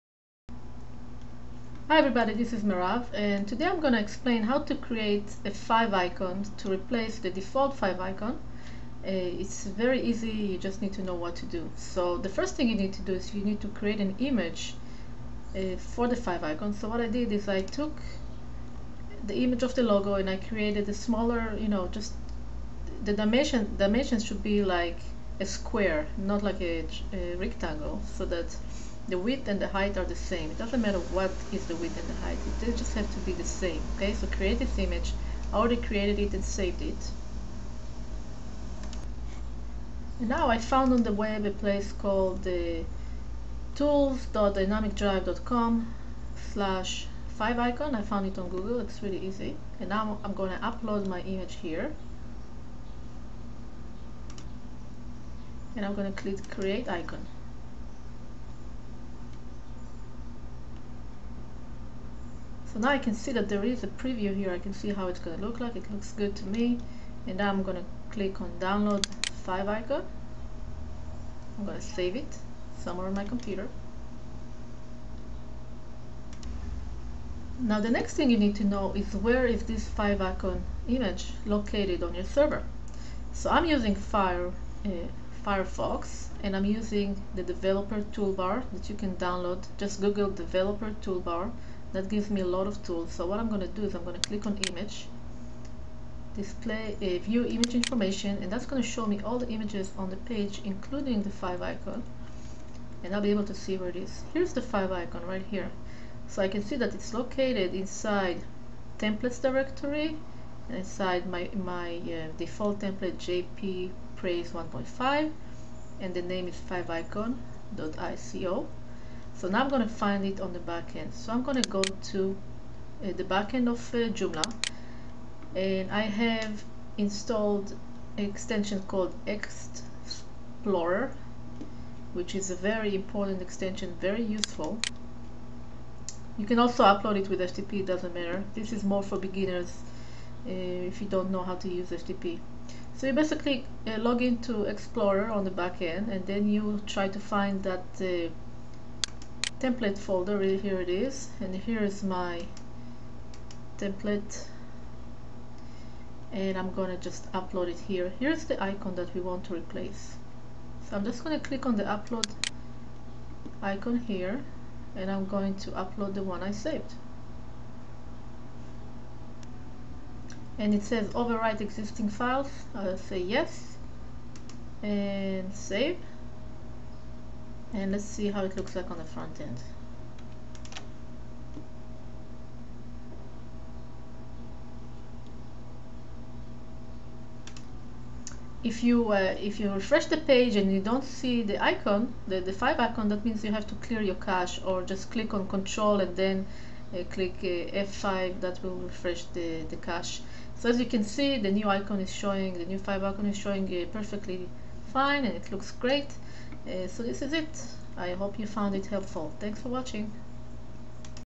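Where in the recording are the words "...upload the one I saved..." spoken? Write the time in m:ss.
2:45.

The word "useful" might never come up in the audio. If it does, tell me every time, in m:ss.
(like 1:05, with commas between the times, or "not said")
2:14.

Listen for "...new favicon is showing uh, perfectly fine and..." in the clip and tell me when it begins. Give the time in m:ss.
3:22.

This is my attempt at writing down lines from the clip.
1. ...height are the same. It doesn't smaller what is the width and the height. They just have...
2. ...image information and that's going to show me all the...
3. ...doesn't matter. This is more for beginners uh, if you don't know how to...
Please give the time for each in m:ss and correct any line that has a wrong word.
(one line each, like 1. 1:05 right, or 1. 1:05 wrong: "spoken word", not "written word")
1. 0:29 wrong: "matter", not "smaller"
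2. 1:37 right
3. 2:17 right.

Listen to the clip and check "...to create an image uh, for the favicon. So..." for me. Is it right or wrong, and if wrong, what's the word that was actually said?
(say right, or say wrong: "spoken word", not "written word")
right.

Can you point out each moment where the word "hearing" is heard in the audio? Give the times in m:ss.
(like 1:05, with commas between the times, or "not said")
not said.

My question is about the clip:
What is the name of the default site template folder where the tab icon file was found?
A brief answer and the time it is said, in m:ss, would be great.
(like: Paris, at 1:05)
JP Praise 1.5, at 1:53.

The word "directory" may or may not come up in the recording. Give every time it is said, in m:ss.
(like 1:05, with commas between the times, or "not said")
1:49.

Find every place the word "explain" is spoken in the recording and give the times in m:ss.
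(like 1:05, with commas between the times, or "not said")
0:03.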